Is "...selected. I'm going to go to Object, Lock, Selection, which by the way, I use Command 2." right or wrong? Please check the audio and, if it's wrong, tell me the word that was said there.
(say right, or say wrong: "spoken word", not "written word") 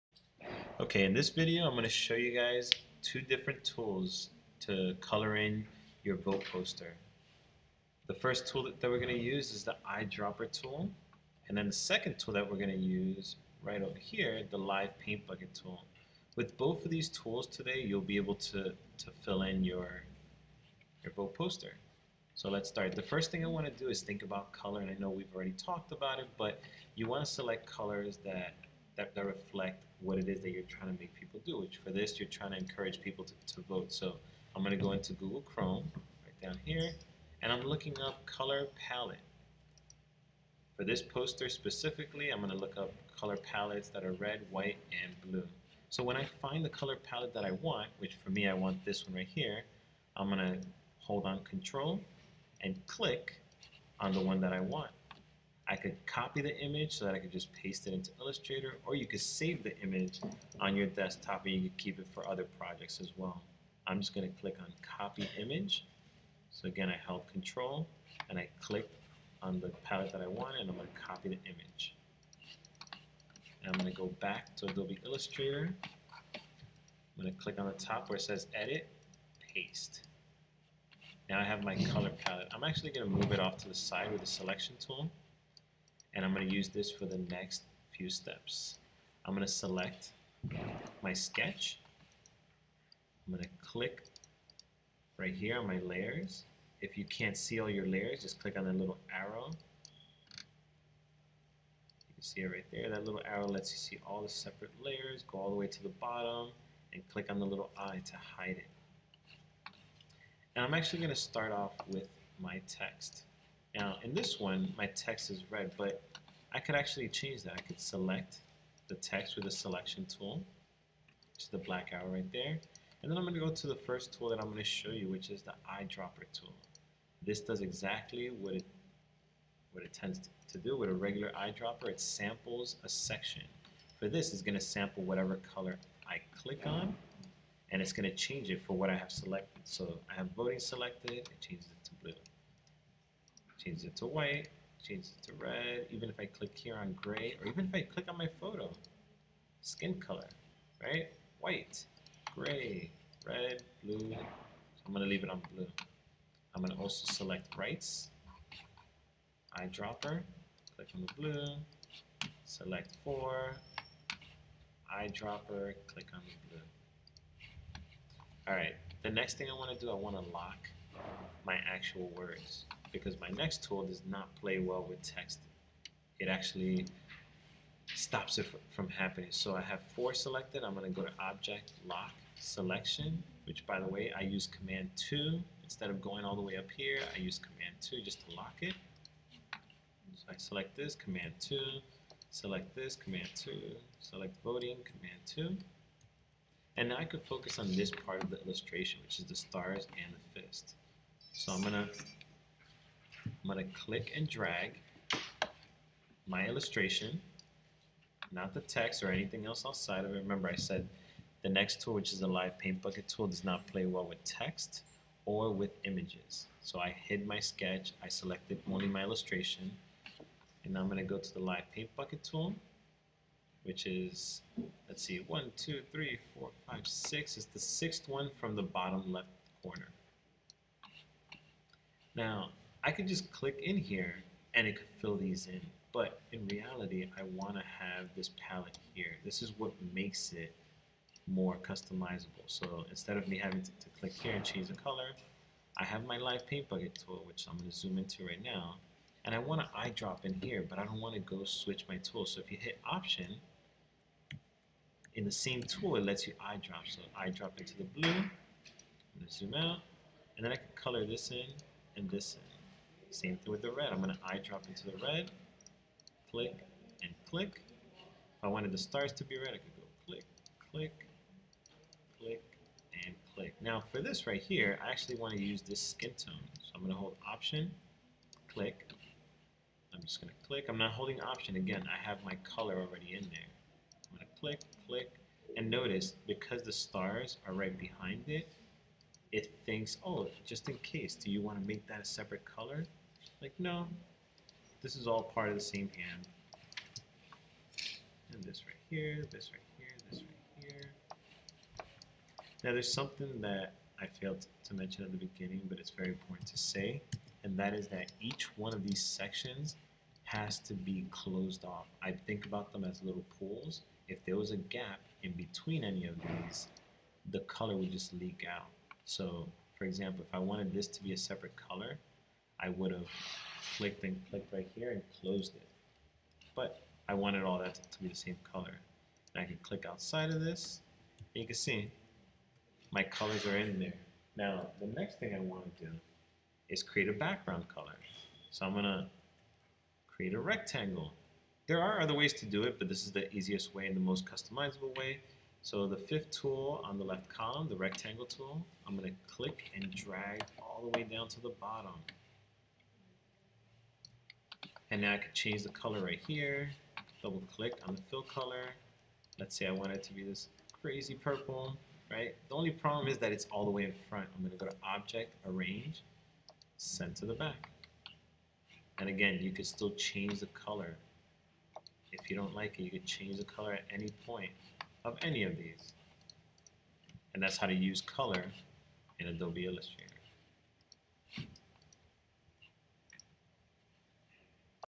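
right.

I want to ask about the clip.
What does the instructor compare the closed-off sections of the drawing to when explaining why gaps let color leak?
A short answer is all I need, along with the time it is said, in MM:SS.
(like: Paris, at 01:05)
little pools, at 05:13.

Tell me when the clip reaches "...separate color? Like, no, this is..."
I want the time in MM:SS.
04:52.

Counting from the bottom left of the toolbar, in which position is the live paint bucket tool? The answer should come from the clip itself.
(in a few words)
sixth.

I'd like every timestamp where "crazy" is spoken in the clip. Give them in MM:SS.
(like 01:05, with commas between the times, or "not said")
06:00.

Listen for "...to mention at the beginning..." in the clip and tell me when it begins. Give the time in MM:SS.
05:04.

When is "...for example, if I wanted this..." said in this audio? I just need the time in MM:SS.
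05:19.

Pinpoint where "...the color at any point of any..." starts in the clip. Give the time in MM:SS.
06:13.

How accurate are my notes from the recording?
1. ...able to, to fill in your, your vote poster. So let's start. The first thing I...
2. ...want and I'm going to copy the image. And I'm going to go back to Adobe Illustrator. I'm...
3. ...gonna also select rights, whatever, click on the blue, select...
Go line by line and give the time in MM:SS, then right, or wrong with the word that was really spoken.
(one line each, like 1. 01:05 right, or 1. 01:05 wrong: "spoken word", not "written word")
1. 00:18 right
2. 01:10 right
3. 02:36 wrong: "eyedropper", not "whatever".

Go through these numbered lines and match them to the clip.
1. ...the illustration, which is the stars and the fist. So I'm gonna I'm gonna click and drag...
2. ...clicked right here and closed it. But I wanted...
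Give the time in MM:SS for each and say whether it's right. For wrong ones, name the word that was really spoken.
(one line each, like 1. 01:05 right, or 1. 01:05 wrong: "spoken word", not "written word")
1. 03:18 right
2. 05:24 right.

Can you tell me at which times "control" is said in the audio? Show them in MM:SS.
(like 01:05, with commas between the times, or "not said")
00:51, 01:07.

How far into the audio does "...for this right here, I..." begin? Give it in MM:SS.
04:33.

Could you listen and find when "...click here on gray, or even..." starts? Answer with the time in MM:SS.
02:26.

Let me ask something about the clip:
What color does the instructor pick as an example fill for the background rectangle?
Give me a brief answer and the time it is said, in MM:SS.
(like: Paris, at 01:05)
purple, at 06:00.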